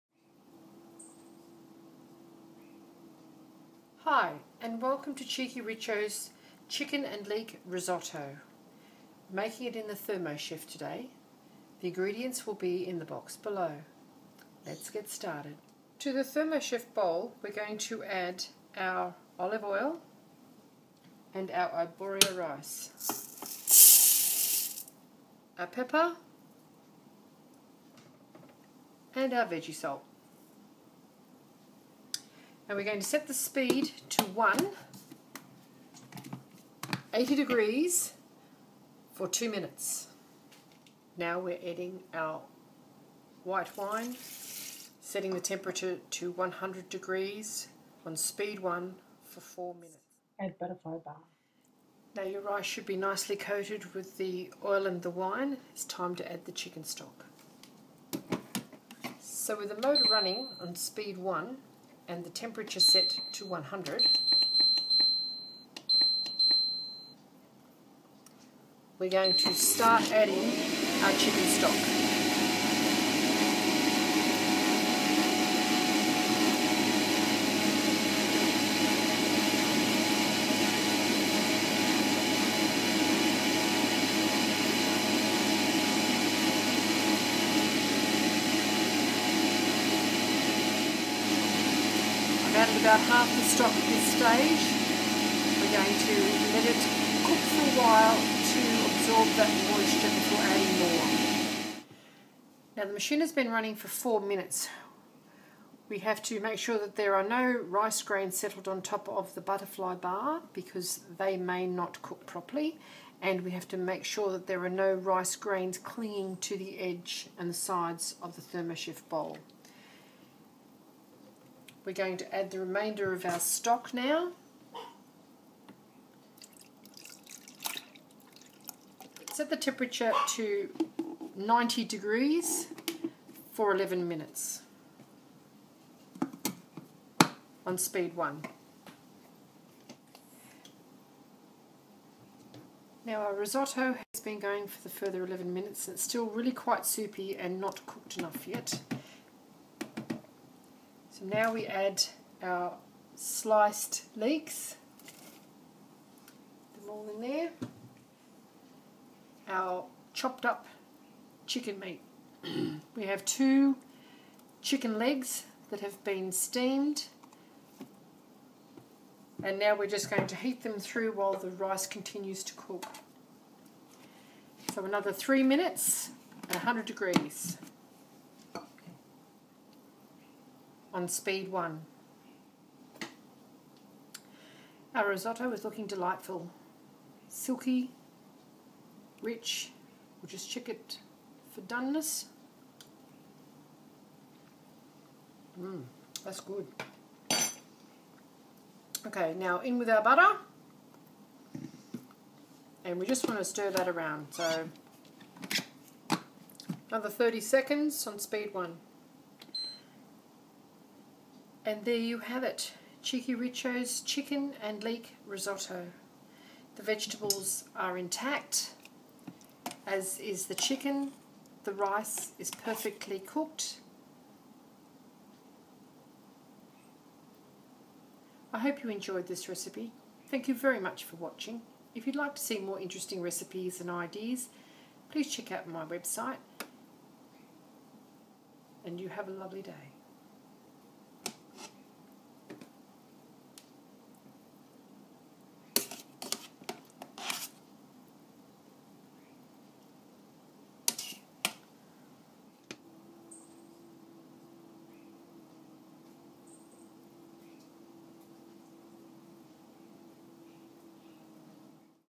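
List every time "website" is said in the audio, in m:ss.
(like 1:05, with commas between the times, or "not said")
3:55.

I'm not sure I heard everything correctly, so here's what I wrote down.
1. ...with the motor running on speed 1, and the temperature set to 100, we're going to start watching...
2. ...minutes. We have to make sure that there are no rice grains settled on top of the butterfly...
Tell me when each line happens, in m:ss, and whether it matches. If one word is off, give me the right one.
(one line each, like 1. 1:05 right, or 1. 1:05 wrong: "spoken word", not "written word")
1. 0:59 wrong: "adding", not "watching"
2. 1:44 right.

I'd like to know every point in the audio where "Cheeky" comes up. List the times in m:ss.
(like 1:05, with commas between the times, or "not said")
0:05, 3:33.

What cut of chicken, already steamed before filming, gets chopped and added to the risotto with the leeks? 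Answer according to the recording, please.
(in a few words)
Chicken legs.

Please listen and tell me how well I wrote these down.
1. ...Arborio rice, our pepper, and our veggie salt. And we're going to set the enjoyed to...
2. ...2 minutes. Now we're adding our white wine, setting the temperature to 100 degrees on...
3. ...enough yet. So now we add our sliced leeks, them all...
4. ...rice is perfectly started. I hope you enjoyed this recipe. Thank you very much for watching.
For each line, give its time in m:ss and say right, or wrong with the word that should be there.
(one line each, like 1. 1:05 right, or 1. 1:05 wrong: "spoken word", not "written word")
1. 0:21 wrong: "speed", not "enjoyed"
2. 0:39 right
3. 2:28 right
4. 3:41 wrong: "cooked", not "started".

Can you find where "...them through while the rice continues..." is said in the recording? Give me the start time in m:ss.
2:50.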